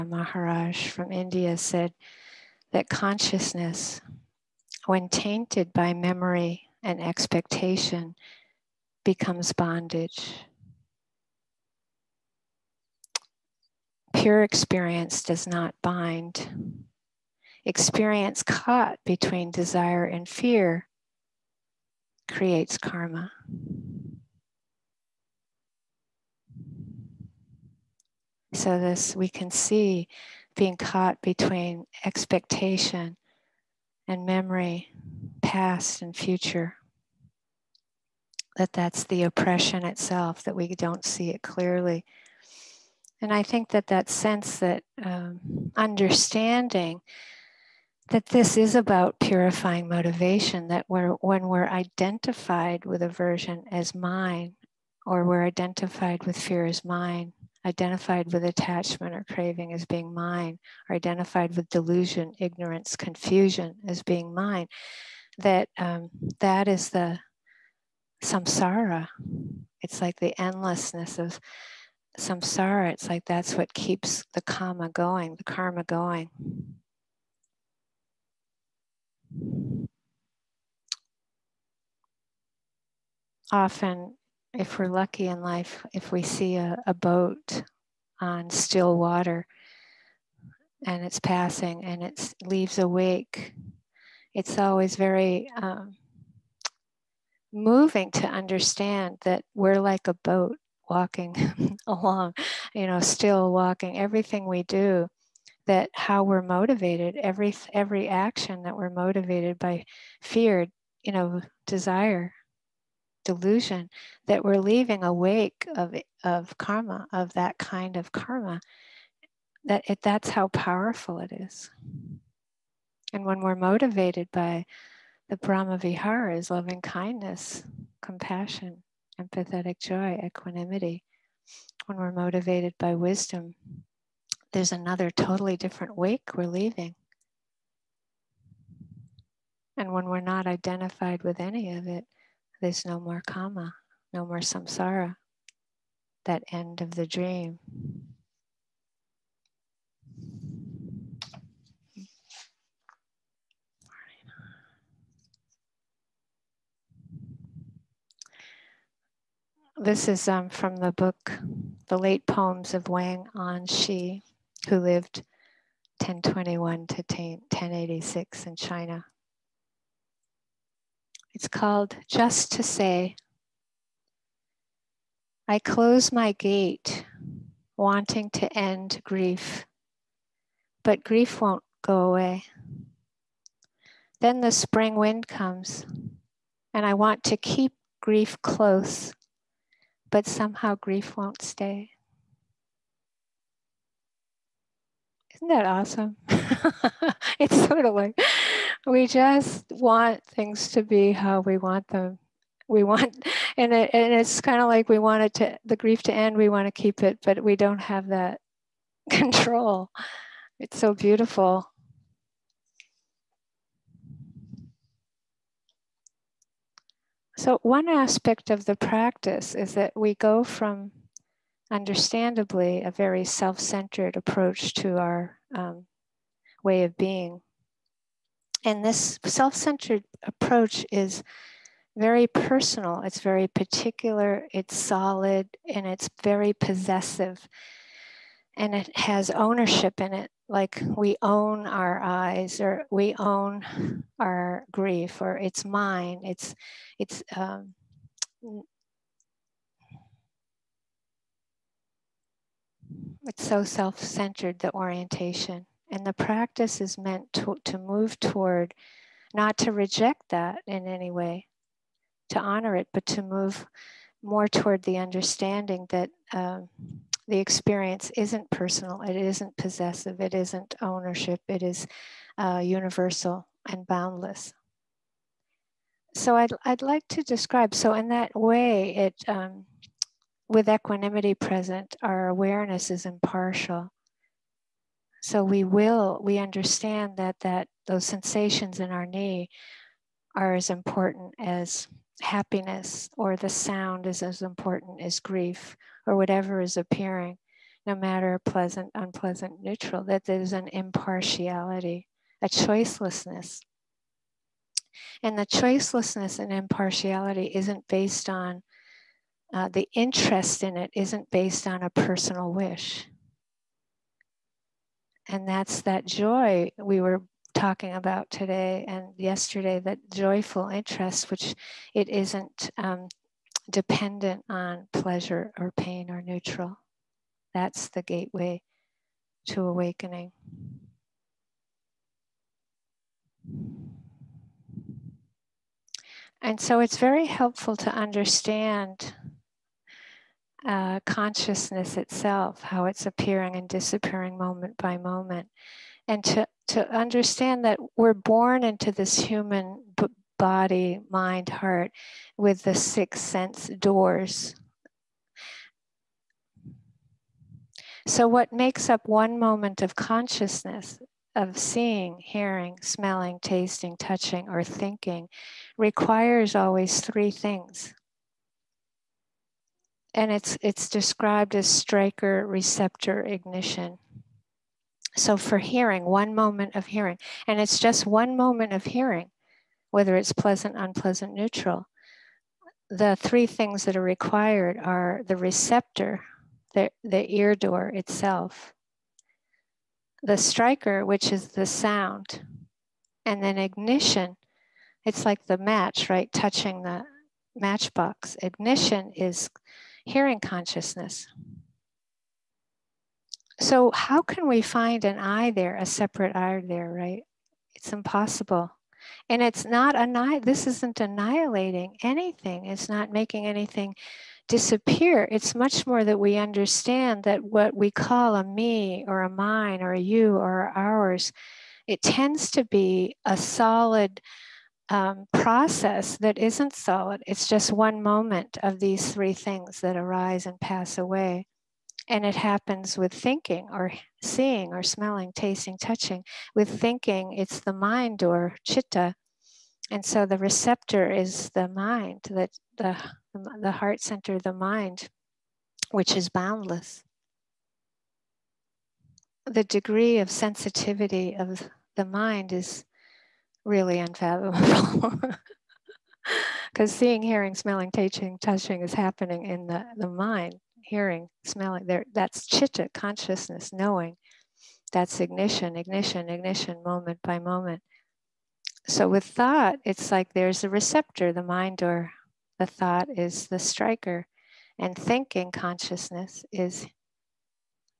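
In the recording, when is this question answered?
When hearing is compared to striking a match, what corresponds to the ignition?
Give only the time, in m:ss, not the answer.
6:40.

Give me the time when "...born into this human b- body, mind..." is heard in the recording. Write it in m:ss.
5:48.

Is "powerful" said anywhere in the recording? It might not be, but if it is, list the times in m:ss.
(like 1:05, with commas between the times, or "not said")
2:00.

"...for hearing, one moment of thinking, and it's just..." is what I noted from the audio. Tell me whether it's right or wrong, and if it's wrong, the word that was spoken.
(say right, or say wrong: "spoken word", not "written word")
wrong: "hearing", not "thinking".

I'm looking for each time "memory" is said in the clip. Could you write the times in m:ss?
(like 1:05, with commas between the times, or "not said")
0:05, 0:34.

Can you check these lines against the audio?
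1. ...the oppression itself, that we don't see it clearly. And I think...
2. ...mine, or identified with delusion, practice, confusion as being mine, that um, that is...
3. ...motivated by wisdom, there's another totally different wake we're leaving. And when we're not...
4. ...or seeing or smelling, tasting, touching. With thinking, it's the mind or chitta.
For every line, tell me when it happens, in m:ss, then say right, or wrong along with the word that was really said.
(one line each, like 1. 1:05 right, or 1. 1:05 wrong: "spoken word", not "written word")
1. 0:39 right
2. 1:00 wrong: "ignorance", not "practice"
3. 2:12 right
4. 7:13 right.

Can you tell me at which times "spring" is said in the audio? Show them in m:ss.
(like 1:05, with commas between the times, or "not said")
3:04.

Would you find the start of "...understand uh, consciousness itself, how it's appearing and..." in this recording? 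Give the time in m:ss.
5:37.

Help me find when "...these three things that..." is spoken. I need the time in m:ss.
7:08.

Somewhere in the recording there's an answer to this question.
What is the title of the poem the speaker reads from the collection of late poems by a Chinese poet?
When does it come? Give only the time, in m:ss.
2:52.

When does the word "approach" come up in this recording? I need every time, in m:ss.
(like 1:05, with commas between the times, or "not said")
3:44, 3:50.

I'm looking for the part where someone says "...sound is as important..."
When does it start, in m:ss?
4:53.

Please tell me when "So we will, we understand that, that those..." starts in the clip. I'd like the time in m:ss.
4:45.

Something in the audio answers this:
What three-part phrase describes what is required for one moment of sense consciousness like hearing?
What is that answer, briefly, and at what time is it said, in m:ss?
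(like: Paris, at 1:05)
Striker receptor ignition, at 6:11.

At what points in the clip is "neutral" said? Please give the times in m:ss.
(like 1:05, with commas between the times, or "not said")
4:59, 5:26, 6:21.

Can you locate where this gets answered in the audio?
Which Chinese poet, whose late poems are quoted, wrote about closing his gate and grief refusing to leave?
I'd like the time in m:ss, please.
2:42.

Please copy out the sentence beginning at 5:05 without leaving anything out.
And the choicelessness and impartiality isn't based on uh, the interest in it, isn't based on a personal wish.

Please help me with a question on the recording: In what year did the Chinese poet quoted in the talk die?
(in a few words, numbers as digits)
1086.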